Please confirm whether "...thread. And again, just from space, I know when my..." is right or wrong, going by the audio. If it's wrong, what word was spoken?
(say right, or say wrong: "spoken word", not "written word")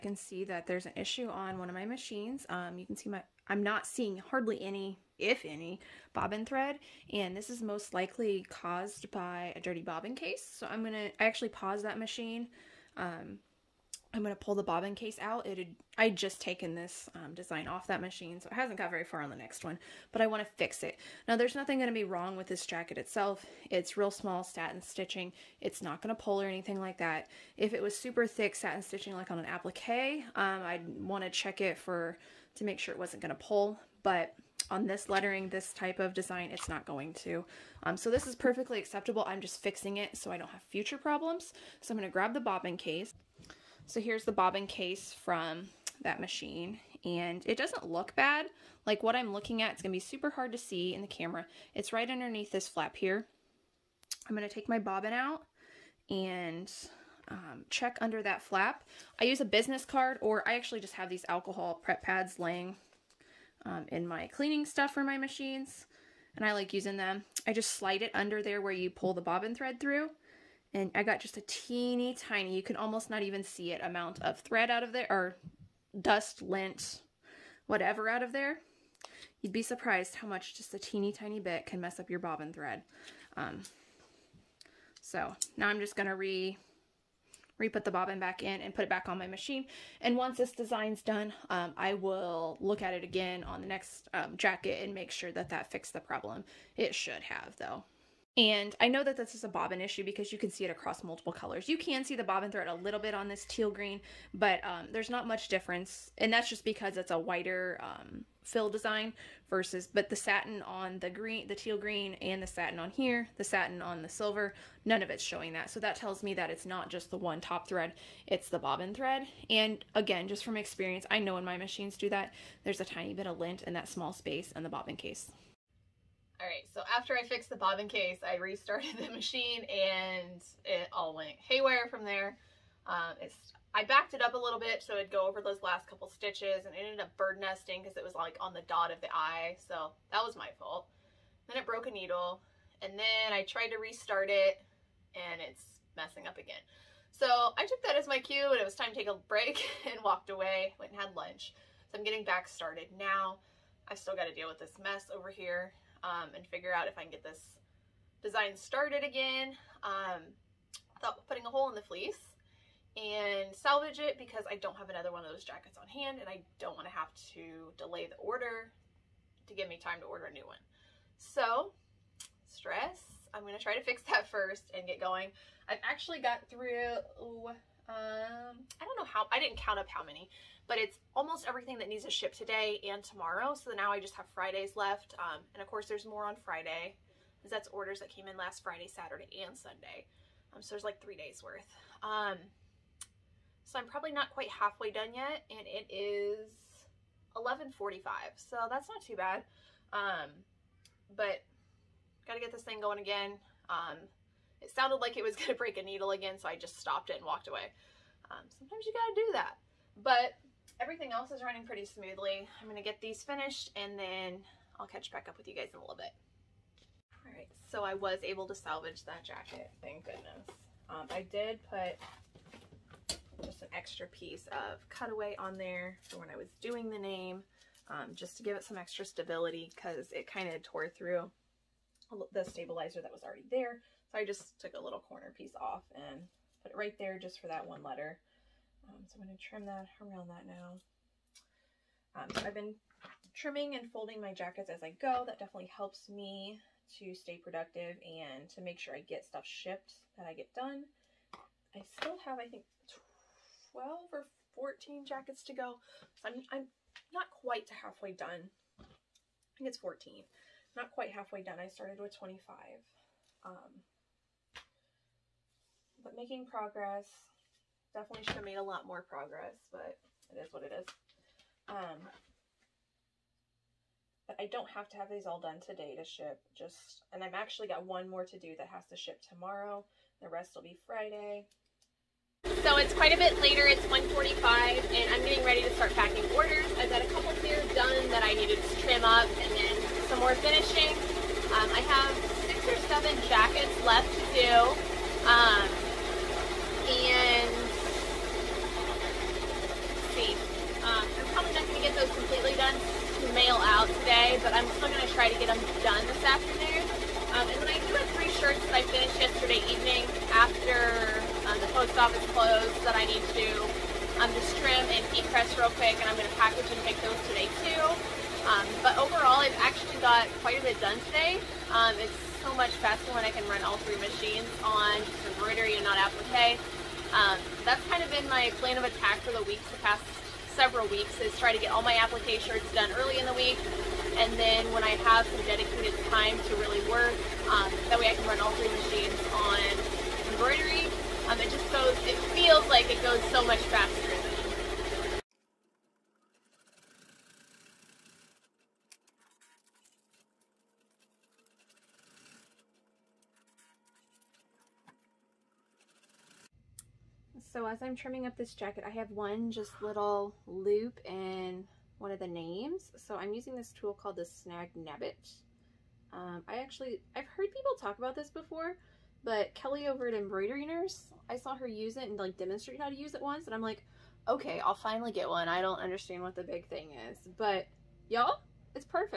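wrong: "experience", not "space".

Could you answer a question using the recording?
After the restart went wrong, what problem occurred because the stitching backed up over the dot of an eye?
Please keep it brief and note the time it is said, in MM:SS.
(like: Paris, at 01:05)
bird nesting, at 02:17.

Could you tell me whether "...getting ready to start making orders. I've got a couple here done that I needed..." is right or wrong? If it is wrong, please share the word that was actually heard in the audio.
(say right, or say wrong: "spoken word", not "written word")
wrong: "packing", not "making".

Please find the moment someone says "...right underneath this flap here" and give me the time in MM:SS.
00:51.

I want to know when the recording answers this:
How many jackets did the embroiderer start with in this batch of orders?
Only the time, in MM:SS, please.
04:22.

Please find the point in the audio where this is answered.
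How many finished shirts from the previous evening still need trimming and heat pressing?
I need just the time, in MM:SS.
05:08.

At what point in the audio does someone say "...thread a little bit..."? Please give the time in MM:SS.
01:42.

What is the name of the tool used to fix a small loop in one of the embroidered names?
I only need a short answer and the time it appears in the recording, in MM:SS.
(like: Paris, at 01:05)
Snag Nab-it, at 06:04.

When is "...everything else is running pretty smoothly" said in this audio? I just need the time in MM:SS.
03:30.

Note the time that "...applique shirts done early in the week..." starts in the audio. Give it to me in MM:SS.
05:31.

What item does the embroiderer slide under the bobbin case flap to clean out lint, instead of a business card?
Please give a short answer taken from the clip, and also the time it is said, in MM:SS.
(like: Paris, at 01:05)
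alcohol prep pads, at 01:01.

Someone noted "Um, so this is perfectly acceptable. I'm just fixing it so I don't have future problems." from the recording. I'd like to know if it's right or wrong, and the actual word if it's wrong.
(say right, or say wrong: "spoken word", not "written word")
right.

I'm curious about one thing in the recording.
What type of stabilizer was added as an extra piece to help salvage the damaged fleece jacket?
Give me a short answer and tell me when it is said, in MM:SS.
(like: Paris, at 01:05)
cutaway, at 03:44.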